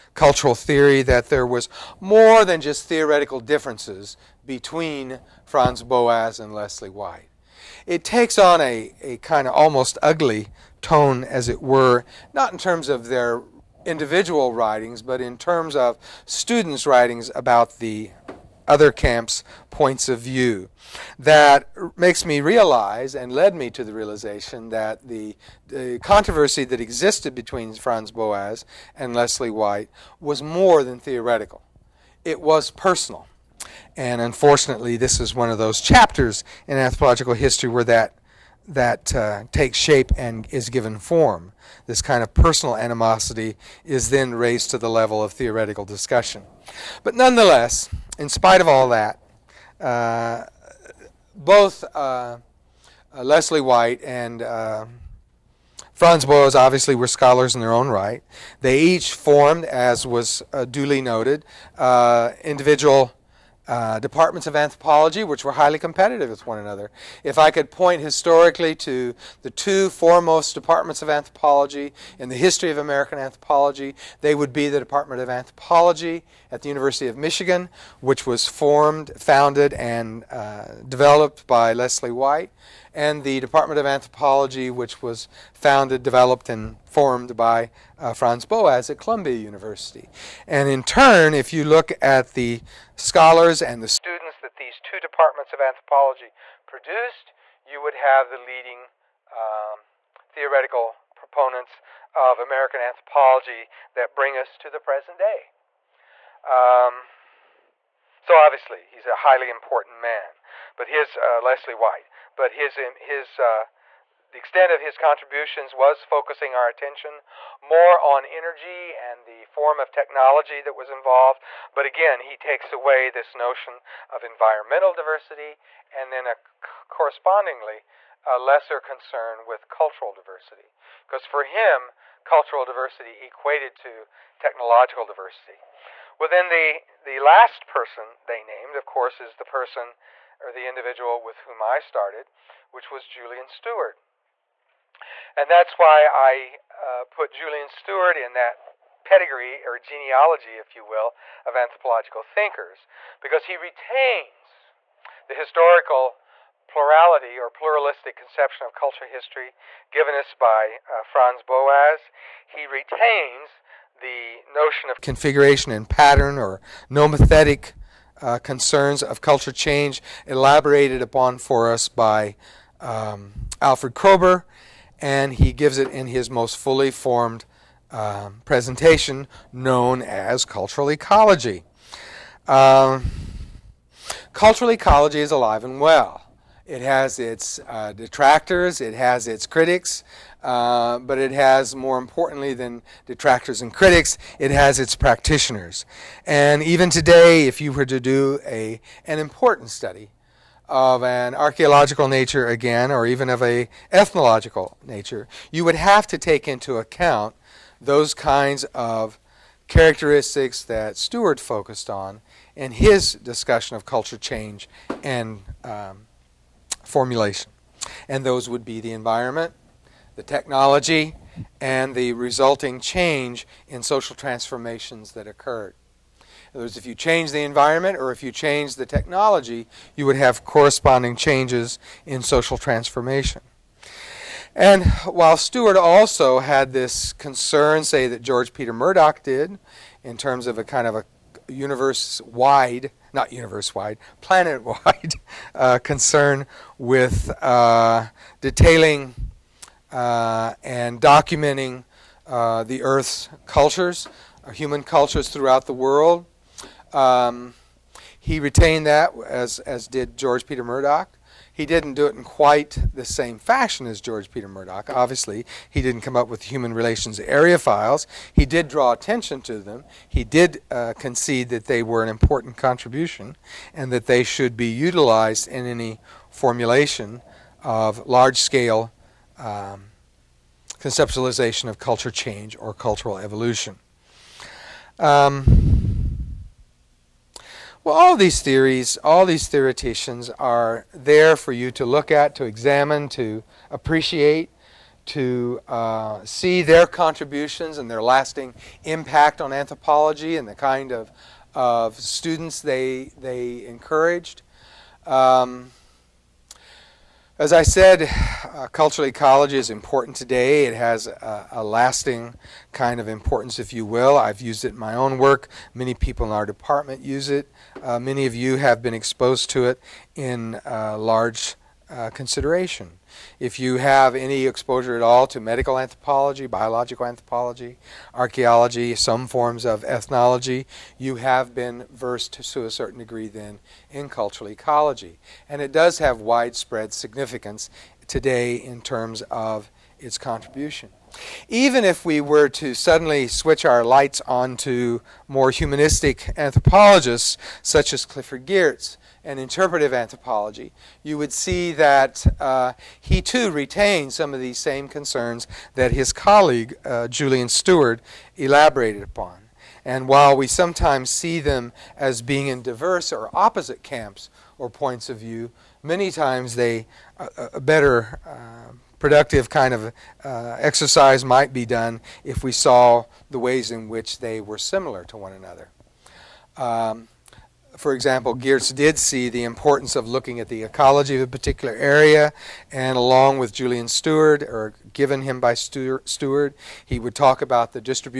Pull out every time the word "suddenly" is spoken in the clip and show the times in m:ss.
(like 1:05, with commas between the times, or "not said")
5:42.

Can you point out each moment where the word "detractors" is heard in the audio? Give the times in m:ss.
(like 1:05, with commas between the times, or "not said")
3:07, 3:13.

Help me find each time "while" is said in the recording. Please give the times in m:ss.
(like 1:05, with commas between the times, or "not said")
3:55, 6:00.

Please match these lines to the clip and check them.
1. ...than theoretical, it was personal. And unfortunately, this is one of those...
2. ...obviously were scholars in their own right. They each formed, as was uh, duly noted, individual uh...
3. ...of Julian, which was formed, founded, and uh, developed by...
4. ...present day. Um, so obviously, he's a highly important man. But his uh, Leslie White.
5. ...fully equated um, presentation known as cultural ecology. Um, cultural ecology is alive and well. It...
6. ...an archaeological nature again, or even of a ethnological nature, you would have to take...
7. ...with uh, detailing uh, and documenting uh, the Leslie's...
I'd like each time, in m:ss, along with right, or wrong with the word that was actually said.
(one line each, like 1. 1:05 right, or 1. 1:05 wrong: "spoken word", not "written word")
1. 0:30 right
2. 0:56 right
3. 1:17 wrong: "Michigan", not "Julian"
4. 1:44 right
5. 2:56 wrong: "formed", not "equated"
6. 3:21 right
7. 4:06 wrong: "Earth", not "Leslie".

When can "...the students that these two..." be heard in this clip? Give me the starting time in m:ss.
1:33.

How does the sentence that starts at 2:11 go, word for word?
Because for him, cultural diversity equated to technological diversity.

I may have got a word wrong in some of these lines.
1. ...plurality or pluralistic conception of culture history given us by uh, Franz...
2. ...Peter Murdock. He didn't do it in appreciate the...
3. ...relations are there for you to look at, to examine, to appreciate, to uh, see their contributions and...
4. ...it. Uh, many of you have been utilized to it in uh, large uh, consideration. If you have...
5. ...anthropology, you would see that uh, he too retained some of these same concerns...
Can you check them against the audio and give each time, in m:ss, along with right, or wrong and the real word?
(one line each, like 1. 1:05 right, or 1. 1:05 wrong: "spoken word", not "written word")
1. 2:36 right
2. 4:20 wrong: "quite", not "appreciate"
3. 4:49 wrong: "theoreticians", not "relations"
4. 5:17 wrong: "exposed", not "utilized"
5. 5:49 right.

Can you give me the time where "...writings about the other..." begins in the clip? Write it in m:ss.
0:16.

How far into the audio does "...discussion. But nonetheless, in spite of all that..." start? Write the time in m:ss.
0:45.